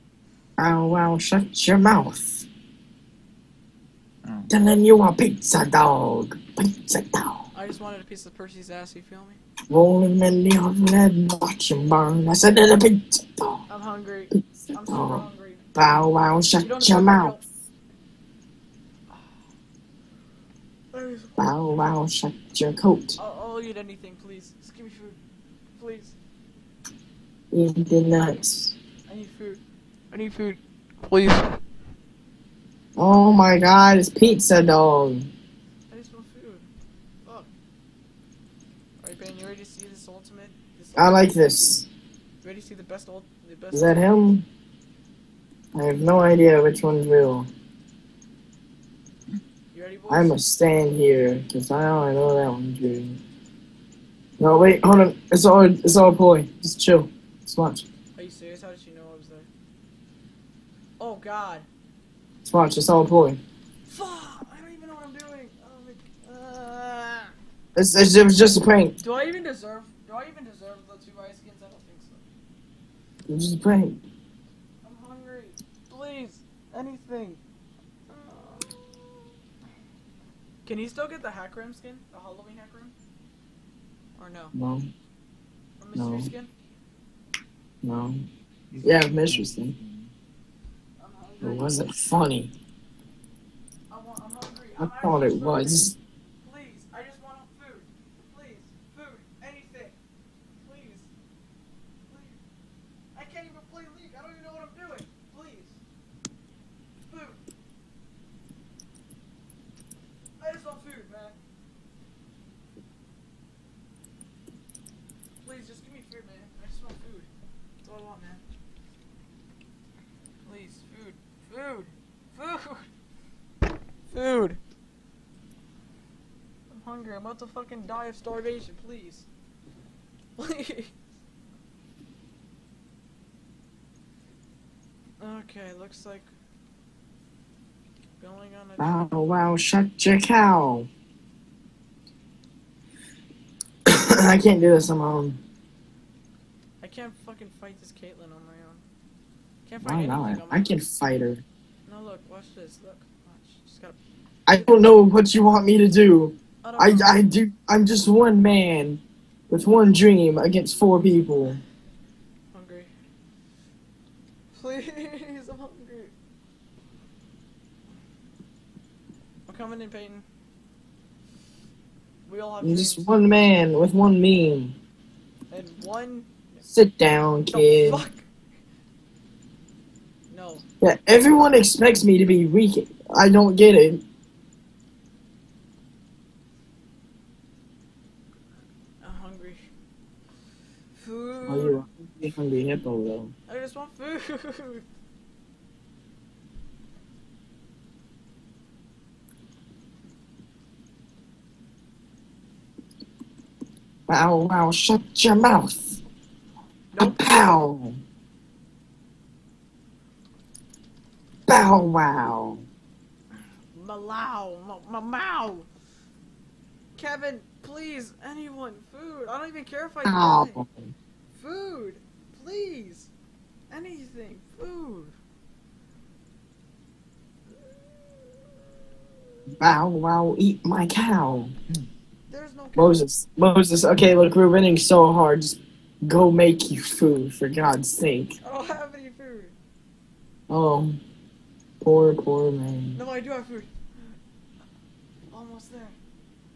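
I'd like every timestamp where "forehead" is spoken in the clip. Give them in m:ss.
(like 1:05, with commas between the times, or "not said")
not said.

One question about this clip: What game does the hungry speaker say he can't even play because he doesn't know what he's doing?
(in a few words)
League.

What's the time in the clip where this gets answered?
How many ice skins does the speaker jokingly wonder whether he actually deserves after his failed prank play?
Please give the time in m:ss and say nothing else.
1:11.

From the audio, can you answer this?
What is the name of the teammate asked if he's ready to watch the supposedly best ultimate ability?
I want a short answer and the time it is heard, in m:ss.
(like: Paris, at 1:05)
Ben, at 0:39.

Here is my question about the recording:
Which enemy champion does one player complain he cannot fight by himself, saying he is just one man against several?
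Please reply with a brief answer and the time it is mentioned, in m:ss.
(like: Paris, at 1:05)
Caitlyn, at 2:27.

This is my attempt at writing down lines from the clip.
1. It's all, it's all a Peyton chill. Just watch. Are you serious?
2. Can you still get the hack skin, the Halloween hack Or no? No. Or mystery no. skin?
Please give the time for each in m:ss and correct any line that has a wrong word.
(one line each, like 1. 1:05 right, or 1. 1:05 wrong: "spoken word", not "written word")
1. 0:55 wrong: "Just", not "Peyton"
2. 1:20 right.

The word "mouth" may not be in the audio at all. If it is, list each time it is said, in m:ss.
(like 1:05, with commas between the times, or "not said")
0:01, 0:17, 3:25.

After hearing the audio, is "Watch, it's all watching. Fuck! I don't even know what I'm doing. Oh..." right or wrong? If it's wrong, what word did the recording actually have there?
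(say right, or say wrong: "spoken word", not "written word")
wrong: "pulling", not "watching".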